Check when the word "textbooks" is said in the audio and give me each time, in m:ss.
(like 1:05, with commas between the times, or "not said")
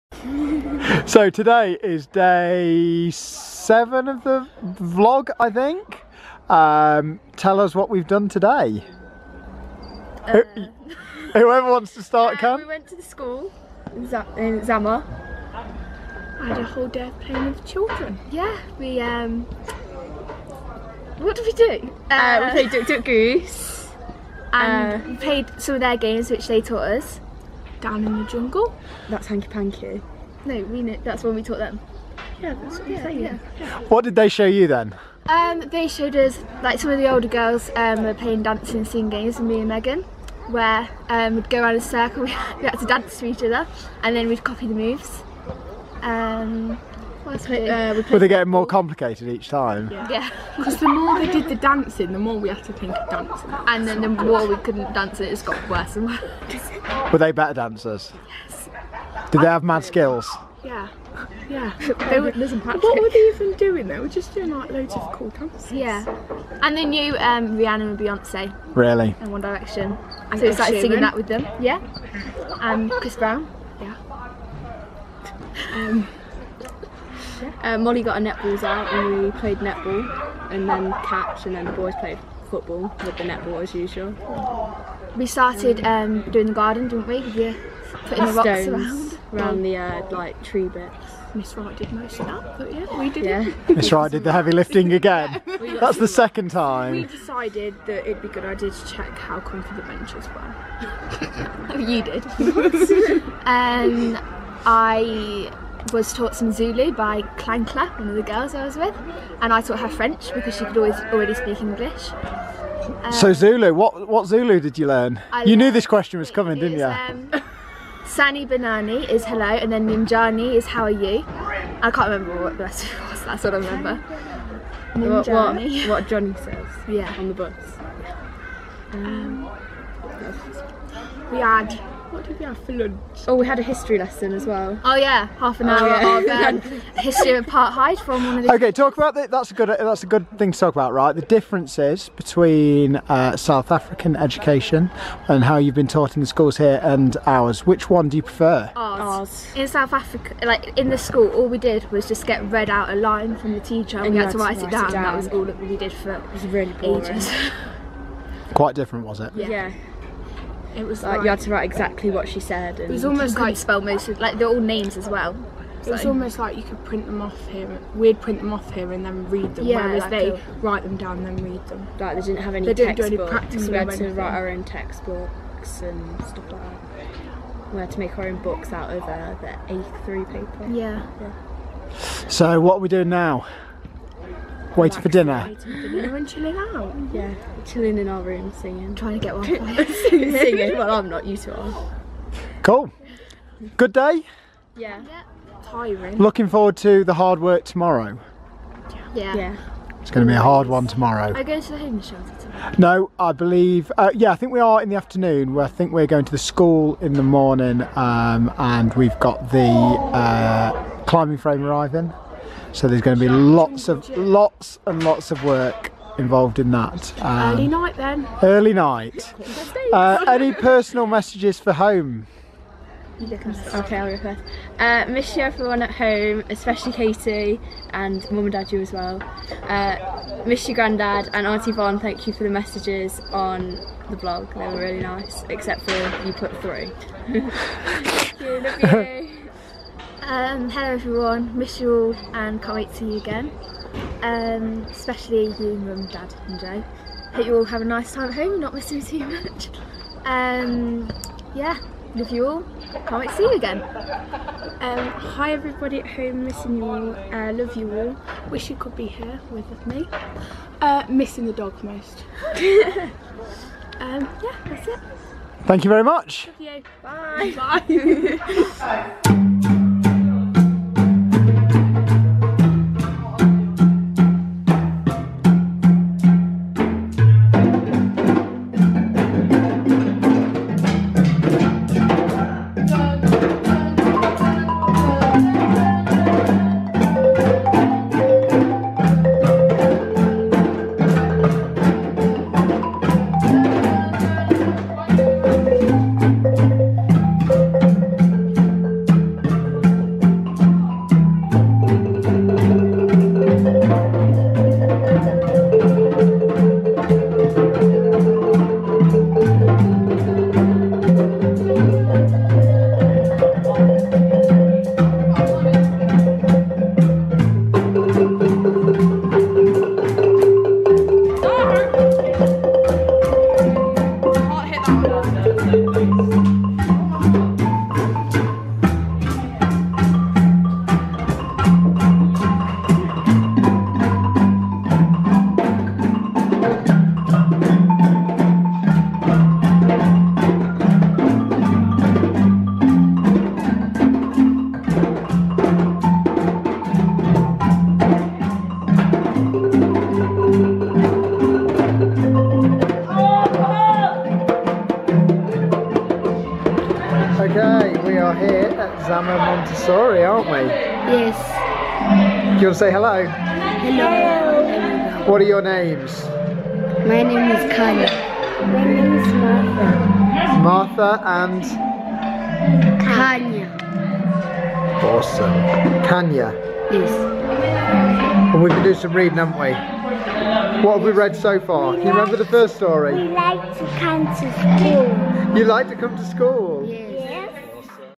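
2:54.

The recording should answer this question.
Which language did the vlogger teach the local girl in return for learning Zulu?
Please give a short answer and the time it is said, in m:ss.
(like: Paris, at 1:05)
French, at 1:49.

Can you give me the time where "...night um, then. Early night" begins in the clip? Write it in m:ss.
3:37.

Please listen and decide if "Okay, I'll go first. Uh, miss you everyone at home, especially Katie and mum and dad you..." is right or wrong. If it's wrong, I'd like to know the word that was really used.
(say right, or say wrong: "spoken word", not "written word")
right.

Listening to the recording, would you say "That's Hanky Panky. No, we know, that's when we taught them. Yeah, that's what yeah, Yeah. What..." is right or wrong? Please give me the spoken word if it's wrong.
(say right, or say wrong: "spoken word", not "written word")
right.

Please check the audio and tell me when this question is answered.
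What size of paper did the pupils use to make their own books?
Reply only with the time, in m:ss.
2:59.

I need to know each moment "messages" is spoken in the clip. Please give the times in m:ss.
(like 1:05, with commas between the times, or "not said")
3:41, 3:52.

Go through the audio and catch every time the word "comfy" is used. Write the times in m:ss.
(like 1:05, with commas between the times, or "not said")
1:39.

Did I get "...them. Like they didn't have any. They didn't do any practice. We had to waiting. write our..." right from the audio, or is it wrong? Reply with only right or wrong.
wrong.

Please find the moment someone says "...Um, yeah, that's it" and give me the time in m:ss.
4:23.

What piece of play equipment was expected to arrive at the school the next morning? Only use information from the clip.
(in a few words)
climbing frame.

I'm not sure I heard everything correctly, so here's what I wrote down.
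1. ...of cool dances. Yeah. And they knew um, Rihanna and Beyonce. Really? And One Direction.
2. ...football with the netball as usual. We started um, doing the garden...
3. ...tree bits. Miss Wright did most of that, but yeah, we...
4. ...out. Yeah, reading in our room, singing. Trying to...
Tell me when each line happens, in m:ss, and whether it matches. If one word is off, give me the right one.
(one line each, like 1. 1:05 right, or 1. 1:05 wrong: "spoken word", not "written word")
1. 1:04 right
2. 1:22 right
3. 1:30 right
4. 3:06 wrong: "chilling", not "reading".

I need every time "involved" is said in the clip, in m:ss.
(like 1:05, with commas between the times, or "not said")
3:36.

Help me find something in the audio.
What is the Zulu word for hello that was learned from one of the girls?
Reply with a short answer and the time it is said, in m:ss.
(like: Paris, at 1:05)
Sanibonani, at 1:58.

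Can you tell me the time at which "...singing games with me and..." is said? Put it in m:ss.
0:38.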